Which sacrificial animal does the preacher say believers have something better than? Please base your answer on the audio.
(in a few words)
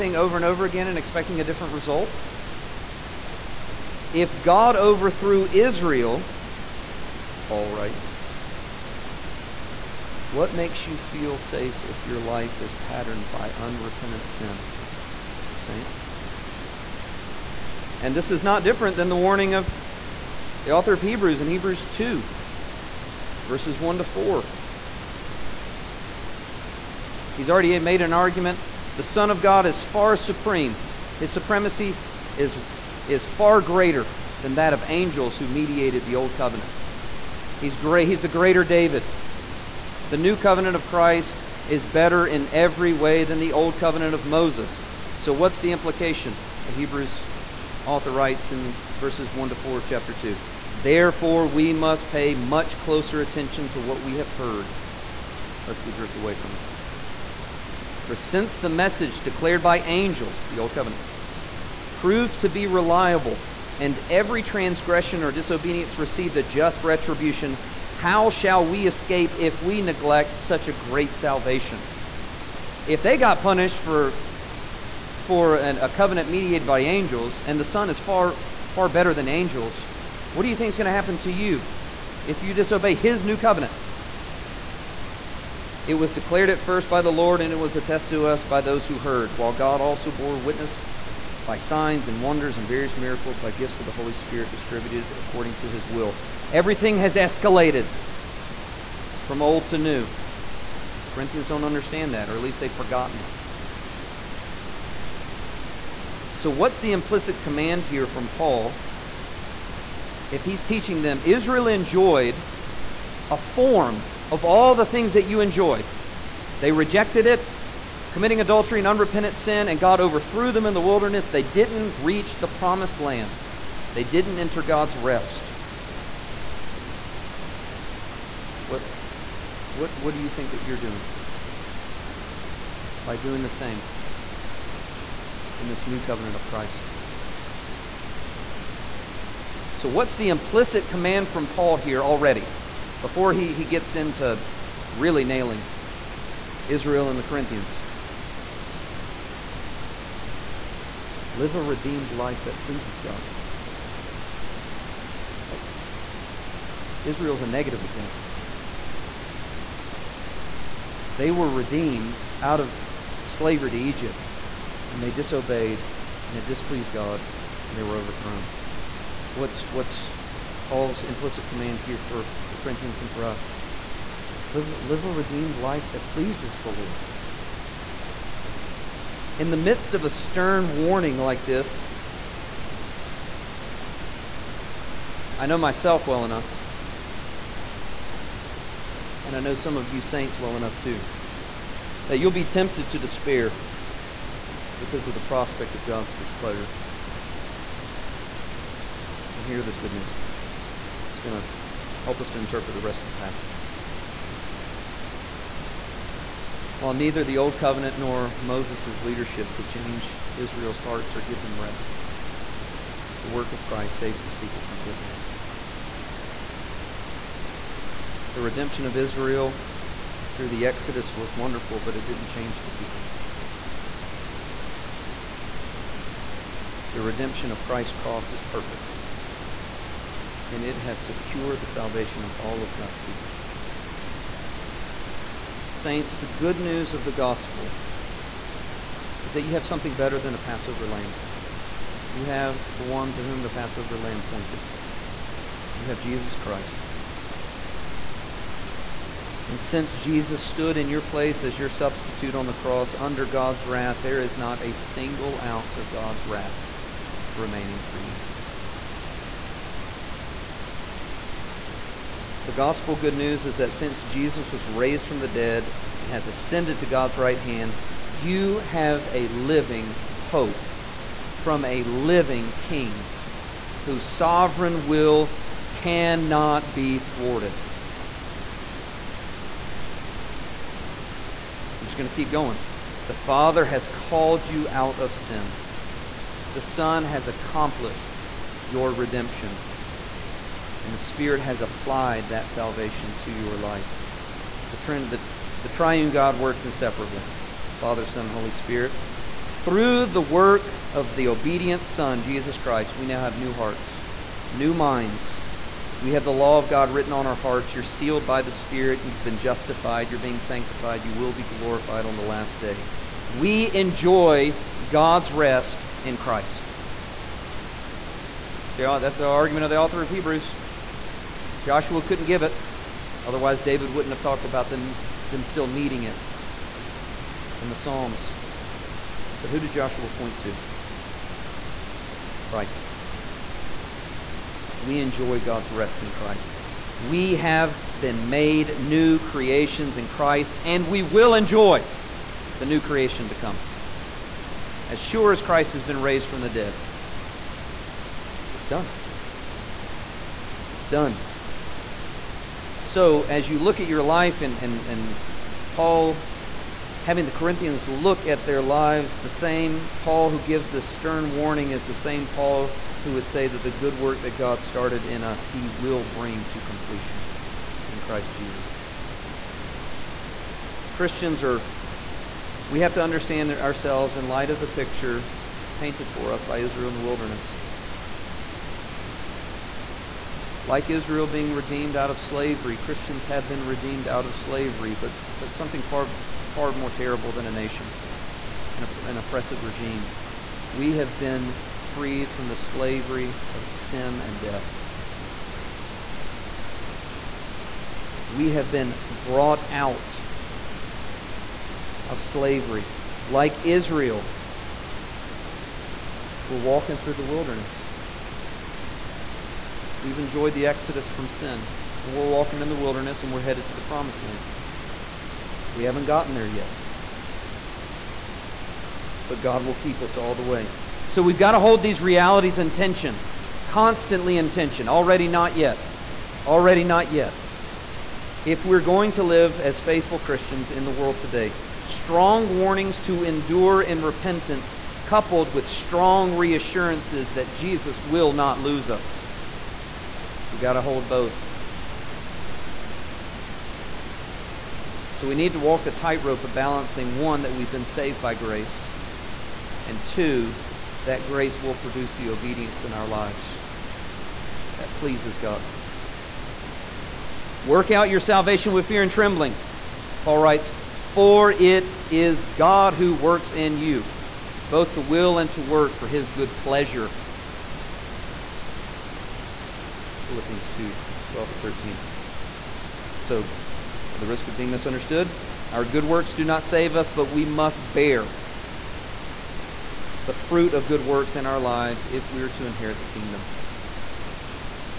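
A Passover lamb.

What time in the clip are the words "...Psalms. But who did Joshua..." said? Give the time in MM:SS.
05:27.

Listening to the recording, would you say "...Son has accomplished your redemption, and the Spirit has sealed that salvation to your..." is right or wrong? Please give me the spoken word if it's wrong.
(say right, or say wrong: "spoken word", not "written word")
wrong: "applied", not "sealed".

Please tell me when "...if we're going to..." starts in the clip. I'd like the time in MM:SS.
07:08.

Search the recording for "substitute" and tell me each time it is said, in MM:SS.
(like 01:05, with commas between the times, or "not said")
04:11.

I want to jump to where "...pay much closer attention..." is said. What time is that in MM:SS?
00:52.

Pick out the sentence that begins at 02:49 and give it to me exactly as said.
What's, what's Paul's implicit command here for the Corinthians and for us?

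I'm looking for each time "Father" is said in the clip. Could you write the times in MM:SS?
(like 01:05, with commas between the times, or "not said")
04:43, 04:57.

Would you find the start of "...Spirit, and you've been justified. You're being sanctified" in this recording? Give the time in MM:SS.
05:08.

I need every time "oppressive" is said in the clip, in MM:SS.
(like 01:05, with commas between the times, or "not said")
06:29.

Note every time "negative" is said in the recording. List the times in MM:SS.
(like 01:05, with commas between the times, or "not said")
02:37.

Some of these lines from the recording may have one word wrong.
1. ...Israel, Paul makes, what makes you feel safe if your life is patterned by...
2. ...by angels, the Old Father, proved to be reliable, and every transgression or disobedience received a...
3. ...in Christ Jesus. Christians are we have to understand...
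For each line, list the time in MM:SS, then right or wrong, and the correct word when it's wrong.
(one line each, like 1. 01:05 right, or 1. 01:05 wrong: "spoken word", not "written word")
1. 00:05 wrong: "writes", not "makes"
2. 00:59 wrong: "Covenant", not "Father"
3. 06:07 right.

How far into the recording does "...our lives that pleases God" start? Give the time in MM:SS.
07:32.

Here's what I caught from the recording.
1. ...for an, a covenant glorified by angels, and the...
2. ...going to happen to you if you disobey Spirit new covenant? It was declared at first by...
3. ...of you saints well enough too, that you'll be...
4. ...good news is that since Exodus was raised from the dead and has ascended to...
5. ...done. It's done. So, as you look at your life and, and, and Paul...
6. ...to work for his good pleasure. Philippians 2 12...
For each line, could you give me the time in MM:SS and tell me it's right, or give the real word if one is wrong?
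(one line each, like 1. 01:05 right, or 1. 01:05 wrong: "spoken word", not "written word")
1. 01:15 wrong: "mediated", not "glorified"
2. 01:20 wrong: "His", not "Spirit"
3. 03:09 right
4. 04:22 wrong: "Jesus", not "Exodus"
5. 05:48 right
6. 07:45 right.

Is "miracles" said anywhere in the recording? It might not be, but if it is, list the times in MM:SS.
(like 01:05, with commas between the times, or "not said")
01:32.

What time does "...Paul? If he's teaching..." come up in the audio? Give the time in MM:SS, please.
01:48.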